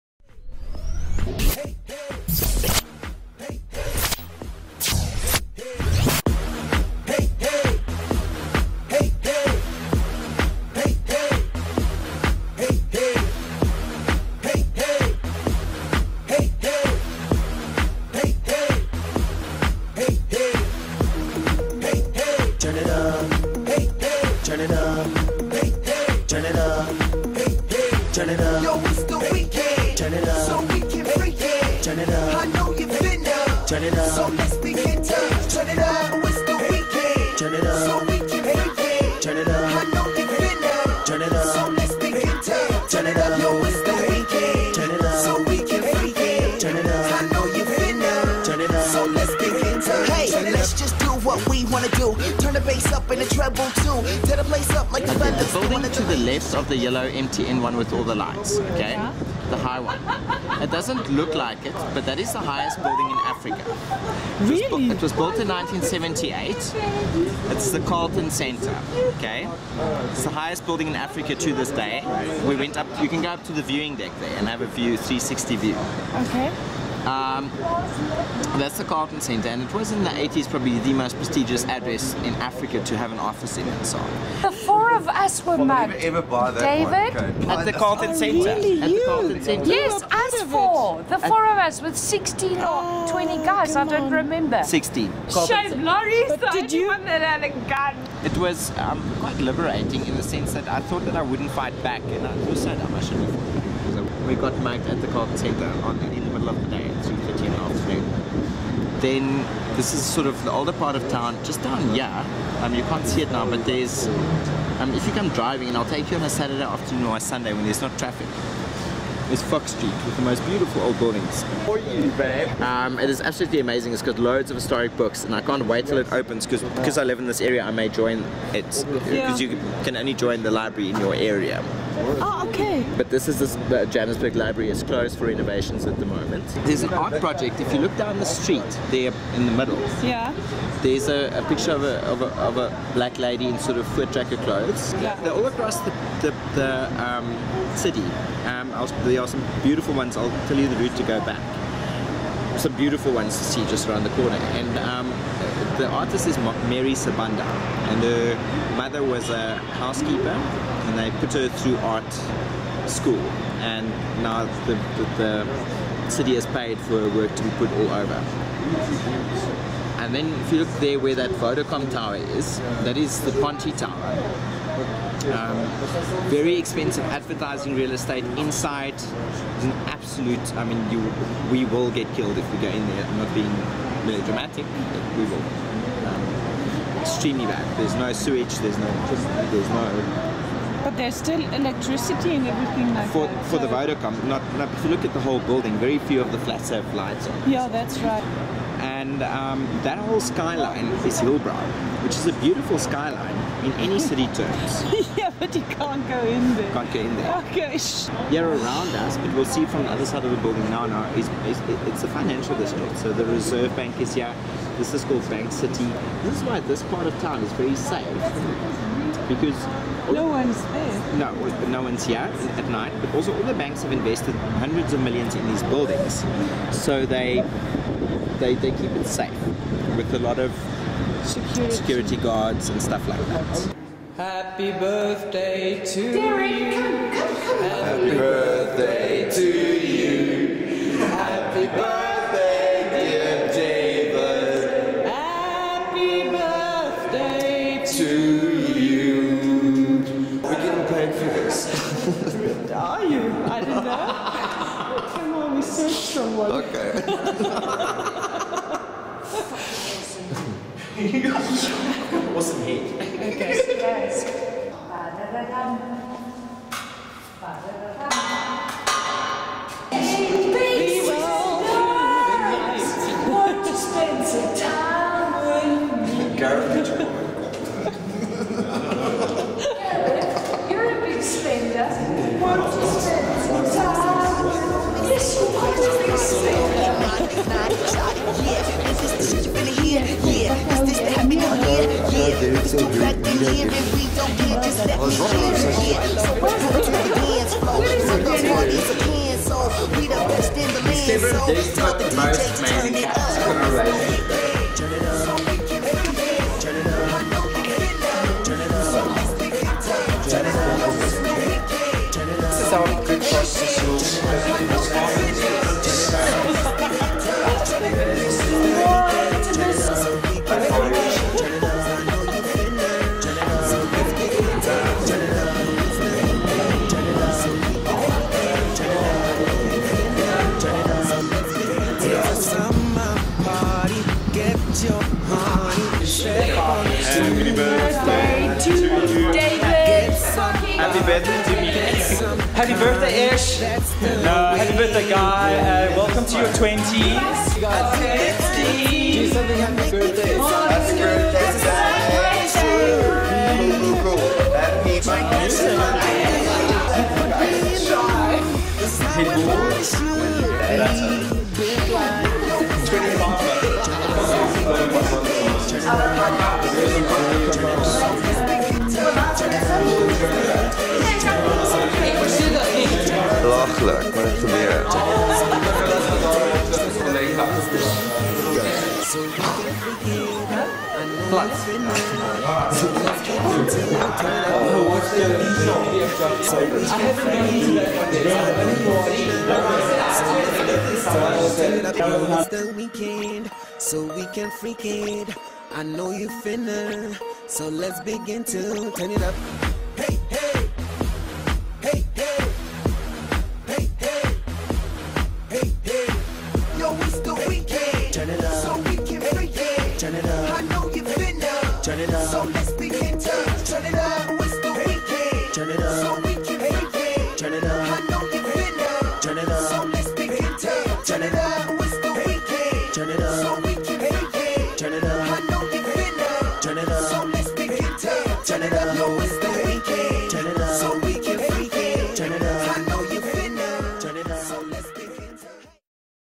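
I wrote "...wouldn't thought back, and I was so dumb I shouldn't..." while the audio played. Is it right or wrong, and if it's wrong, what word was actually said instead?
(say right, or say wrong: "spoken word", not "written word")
wrong: "fight", not "thought".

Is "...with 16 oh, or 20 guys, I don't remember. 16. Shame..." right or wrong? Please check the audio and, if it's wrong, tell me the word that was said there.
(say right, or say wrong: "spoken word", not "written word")
right.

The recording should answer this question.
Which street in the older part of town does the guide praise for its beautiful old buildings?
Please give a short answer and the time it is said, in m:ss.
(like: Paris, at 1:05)
Fox Street, at 1:59.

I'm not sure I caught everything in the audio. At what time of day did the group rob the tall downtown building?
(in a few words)
3:30 in the afternoon.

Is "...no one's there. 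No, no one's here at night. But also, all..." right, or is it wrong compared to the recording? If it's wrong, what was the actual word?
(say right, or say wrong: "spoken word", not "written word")
right.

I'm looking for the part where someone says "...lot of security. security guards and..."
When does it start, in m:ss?
3:50.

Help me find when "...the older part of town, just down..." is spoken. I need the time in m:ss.
1:50.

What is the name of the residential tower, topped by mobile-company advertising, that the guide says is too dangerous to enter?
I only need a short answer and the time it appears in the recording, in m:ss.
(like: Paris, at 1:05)
Ponte Tower, at 2:53.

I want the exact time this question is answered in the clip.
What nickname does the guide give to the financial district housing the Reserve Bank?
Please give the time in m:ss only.
3:35.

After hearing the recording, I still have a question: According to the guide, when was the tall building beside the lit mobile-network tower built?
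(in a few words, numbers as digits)
1978.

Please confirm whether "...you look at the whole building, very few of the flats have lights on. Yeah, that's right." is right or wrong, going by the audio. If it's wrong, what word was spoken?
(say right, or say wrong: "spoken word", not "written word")
right.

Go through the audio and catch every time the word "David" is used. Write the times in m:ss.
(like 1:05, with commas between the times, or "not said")
1:26, 4:03.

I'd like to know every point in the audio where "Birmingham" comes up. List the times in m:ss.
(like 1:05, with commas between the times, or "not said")
not said.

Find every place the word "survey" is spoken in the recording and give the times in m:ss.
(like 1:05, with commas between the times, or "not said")
not said.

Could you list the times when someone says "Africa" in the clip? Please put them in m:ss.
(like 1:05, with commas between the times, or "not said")
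1:03, 1:10, 1:22.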